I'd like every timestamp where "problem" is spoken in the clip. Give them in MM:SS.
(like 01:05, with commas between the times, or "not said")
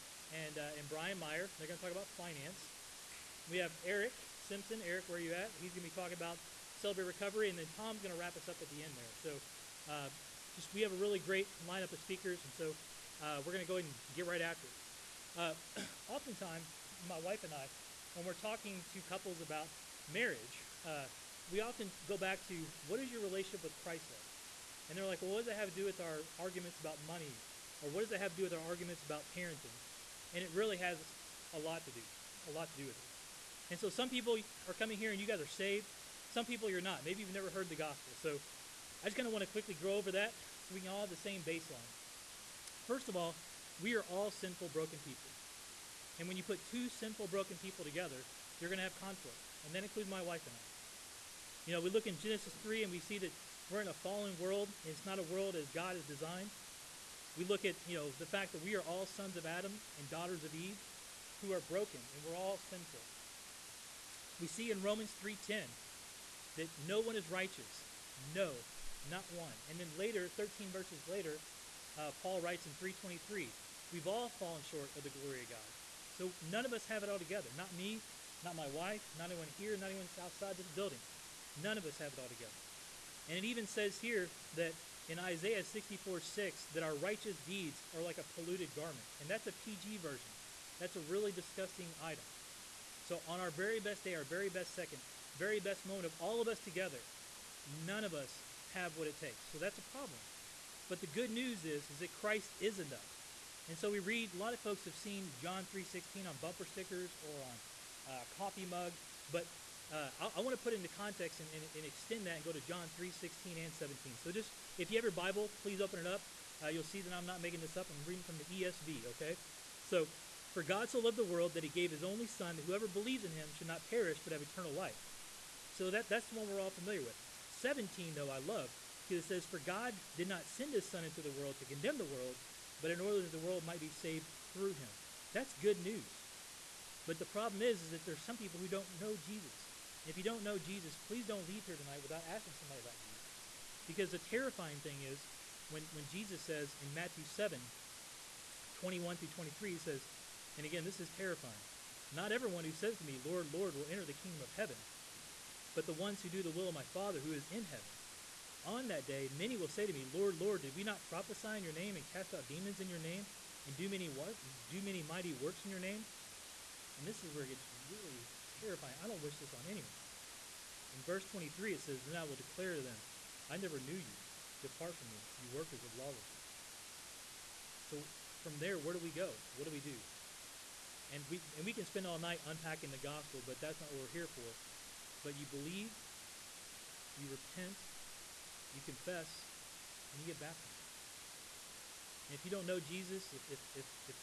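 01:39, 02:17.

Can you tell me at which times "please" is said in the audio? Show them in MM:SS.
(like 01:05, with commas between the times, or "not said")
01:55, 02:21.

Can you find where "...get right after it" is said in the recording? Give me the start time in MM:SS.
00:14.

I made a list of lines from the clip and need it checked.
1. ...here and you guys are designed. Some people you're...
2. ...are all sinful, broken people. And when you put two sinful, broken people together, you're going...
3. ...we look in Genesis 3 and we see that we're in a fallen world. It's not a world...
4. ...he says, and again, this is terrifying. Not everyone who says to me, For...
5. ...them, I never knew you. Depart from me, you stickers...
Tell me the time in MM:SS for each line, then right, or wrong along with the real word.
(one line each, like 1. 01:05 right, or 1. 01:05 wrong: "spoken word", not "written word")
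1. 00:34 wrong: "saved", not "designed"
2. 00:43 right
3. 00:51 right
4. 02:29 wrong: "Lord", not "For"
5. 02:52 wrong: "workers", not "stickers".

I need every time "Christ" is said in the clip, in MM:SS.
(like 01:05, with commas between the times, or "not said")
00:23, 01:42.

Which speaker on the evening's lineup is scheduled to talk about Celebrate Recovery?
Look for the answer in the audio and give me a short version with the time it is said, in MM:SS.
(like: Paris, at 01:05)
Eric Simpson, at 00:03.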